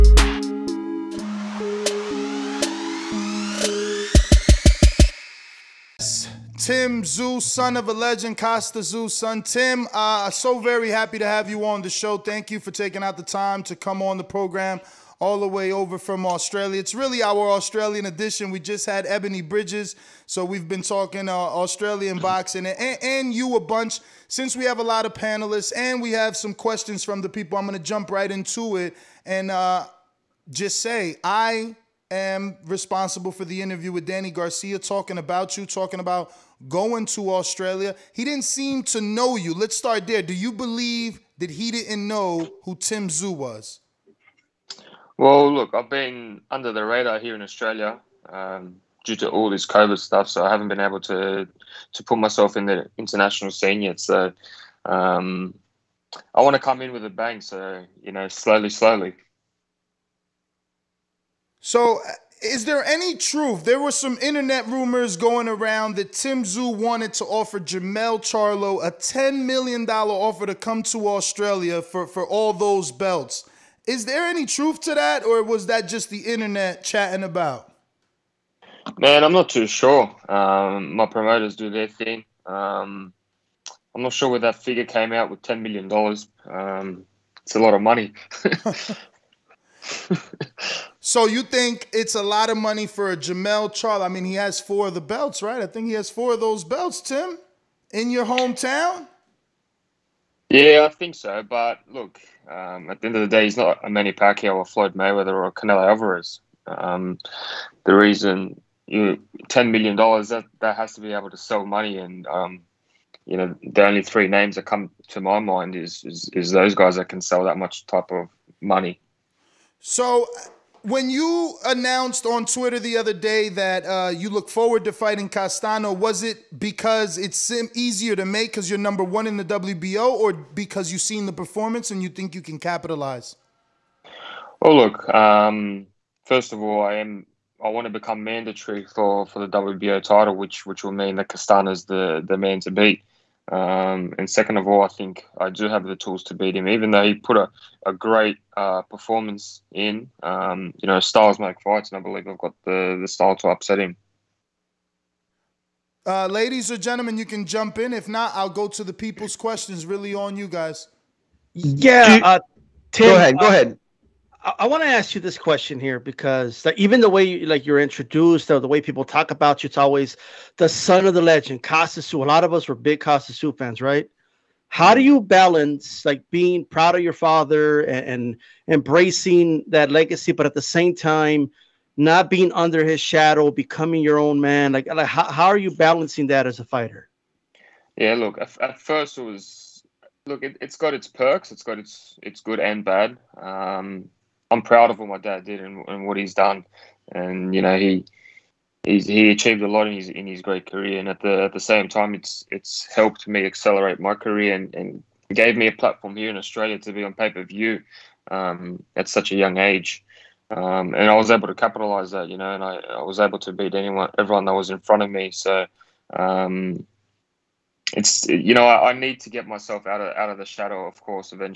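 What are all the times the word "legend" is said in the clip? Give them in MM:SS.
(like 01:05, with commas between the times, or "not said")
00:07, 02:51.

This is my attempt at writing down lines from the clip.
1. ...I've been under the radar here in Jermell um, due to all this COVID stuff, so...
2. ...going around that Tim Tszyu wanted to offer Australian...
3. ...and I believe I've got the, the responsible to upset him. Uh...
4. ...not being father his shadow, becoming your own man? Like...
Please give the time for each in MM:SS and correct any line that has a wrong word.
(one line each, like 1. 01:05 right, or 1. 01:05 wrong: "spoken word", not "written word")
1. 00:45 wrong: "Australia", not "Jermell"
2. 01:05 wrong: "Jermell", not "Australian"
3. 02:31 wrong: "style", not "responsible"
4. 03:01 wrong: "under", not "father".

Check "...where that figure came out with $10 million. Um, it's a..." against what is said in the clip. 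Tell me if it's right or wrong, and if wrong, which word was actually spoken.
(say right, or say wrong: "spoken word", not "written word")
right.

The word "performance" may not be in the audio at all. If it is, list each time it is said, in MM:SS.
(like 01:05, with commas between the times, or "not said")
02:11, 02:28.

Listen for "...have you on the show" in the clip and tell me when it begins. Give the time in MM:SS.
00:11.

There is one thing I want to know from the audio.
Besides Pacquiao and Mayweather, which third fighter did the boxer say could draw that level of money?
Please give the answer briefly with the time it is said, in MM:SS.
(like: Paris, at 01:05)
Canelo Alvarez, at 01:45.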